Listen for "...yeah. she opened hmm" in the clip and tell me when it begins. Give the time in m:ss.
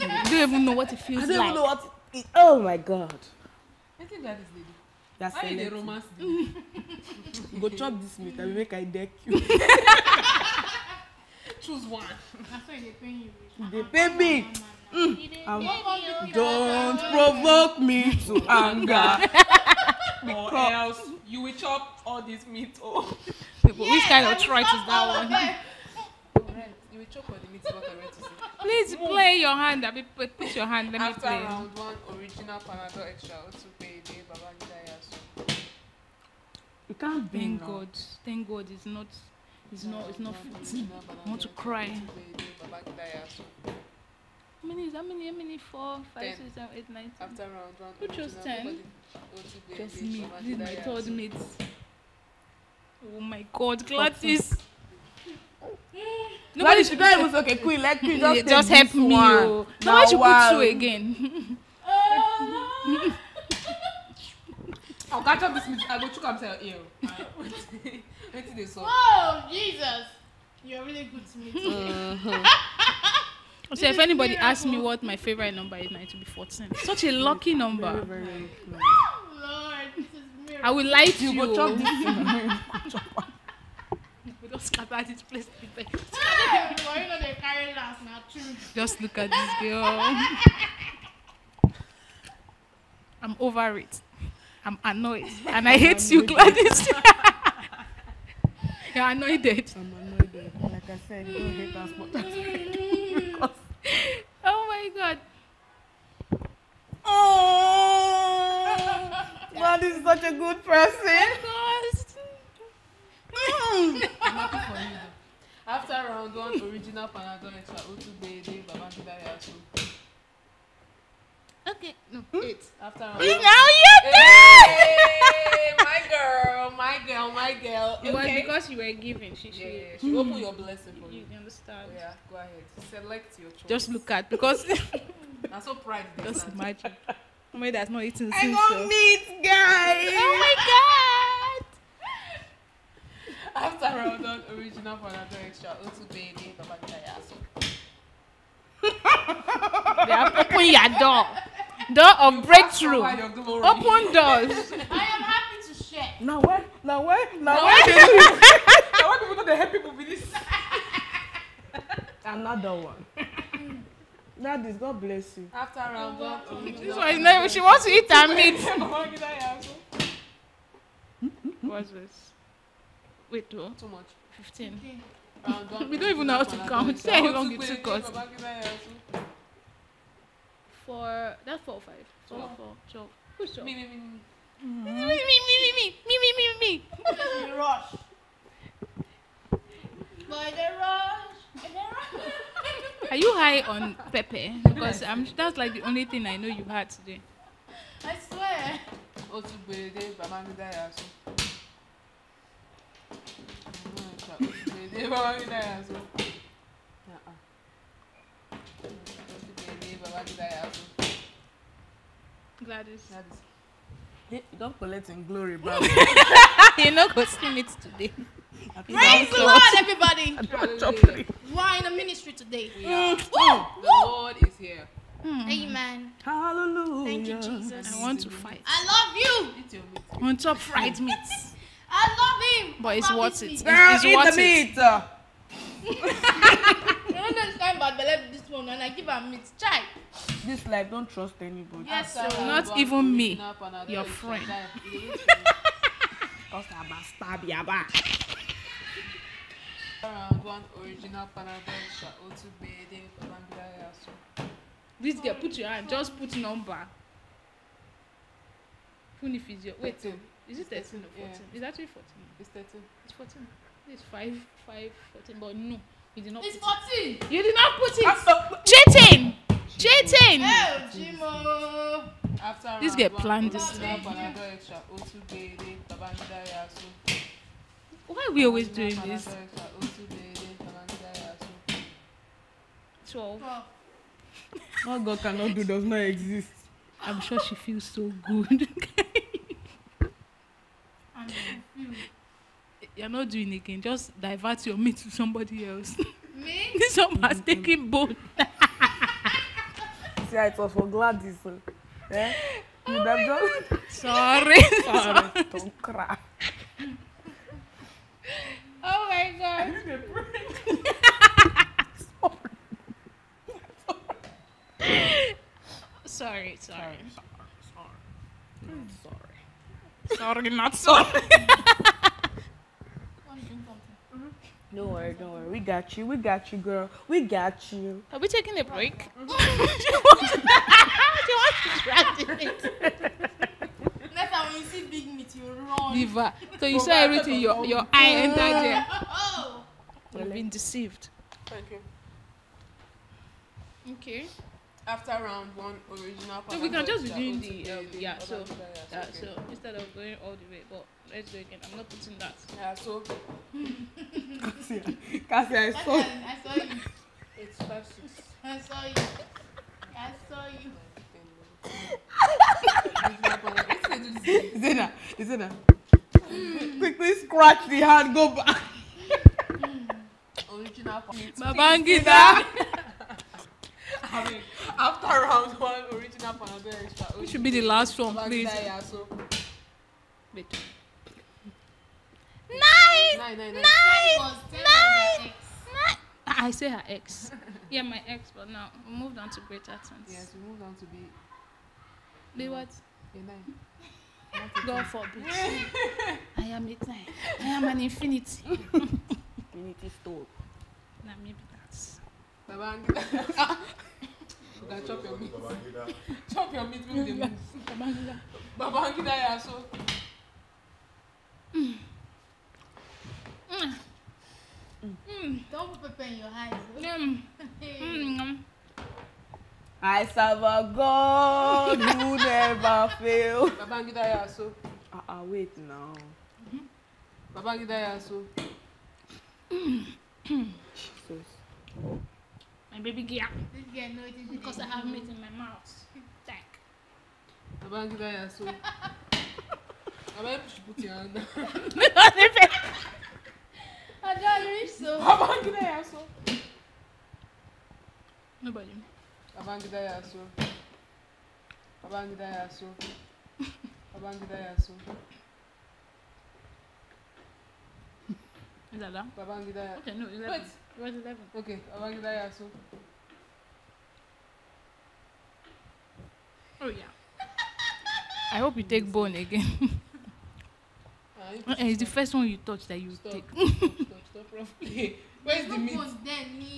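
2:09.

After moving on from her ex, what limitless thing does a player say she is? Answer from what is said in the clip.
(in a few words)
an infinity.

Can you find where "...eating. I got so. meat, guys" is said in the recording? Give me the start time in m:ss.
2:18.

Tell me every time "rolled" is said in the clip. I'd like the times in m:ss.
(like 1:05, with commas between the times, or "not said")
not said.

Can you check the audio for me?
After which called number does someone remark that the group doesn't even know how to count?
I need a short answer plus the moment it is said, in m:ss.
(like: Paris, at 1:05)
15, at 2:54.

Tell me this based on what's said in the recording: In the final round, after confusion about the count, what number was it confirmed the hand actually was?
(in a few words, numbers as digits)
11.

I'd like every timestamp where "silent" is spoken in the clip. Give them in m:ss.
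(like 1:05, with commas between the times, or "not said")
not said.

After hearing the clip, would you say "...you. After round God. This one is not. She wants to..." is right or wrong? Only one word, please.
right.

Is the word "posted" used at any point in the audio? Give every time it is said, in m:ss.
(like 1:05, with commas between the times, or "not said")
not said.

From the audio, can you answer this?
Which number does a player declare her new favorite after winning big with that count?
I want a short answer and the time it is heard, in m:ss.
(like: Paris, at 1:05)
14, at 1:15.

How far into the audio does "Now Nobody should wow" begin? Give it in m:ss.
0:59.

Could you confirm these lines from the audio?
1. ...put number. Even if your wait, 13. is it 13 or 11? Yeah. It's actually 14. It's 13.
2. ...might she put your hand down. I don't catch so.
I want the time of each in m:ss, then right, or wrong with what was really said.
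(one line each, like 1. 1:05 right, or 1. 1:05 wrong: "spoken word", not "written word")
1. 4:16 wrong: "14", not "11"
2. 7:20 wrong: "reach", not "catch".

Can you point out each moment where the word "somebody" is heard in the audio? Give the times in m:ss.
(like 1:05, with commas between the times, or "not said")
2:17, 4:55.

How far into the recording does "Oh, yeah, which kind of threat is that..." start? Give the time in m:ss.
0:22.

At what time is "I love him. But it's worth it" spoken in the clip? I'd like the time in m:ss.
3:51.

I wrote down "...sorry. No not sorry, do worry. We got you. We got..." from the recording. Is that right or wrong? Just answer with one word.
wrong.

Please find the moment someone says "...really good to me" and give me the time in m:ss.
1:10.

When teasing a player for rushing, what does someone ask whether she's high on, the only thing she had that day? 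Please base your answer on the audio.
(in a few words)
Pepe.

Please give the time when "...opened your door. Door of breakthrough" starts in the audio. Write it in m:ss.
2:30.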